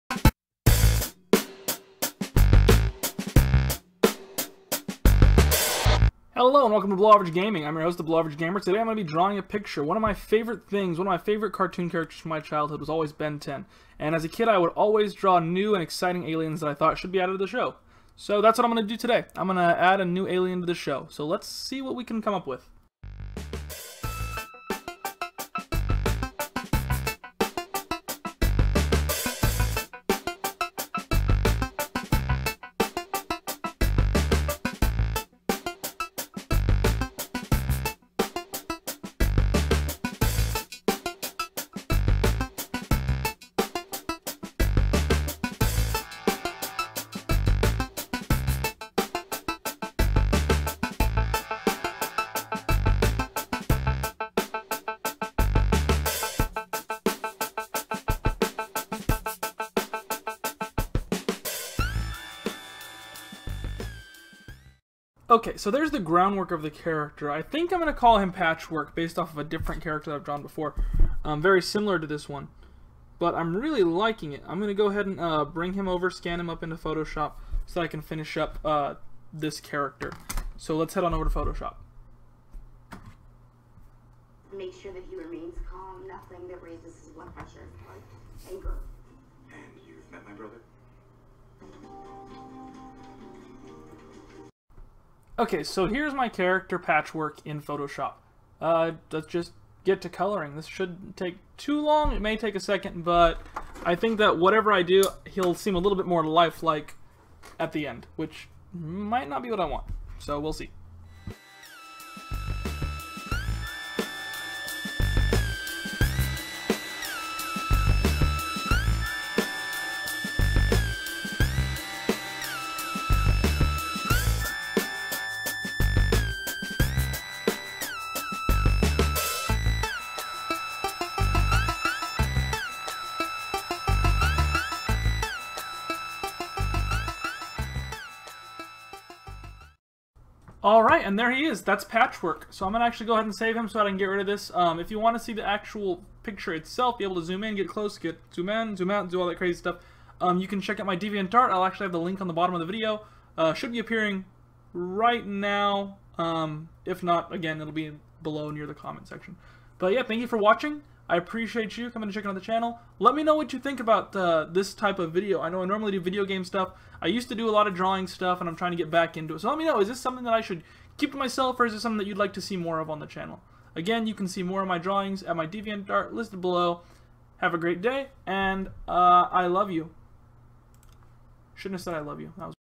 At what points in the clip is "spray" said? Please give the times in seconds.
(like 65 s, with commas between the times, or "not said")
not said.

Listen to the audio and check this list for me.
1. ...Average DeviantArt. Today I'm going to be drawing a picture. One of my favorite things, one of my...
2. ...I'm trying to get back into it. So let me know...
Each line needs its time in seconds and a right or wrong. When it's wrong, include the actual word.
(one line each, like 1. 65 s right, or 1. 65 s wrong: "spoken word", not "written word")
1. 8 s wrong: "Gamer", not "DeviantArt"
2. 168 s right.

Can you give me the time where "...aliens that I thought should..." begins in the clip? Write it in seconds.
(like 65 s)
16 s.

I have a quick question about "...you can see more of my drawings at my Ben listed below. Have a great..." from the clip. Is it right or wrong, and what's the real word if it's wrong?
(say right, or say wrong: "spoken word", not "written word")
wrong: "DeviantArt", not "Ben".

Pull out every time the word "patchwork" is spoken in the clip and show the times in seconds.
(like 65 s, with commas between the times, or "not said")
68 s, 96 s, 141 s.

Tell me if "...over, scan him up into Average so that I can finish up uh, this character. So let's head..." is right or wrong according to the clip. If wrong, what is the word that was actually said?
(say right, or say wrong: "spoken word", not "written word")
wrong: "Photoshop", not "Average".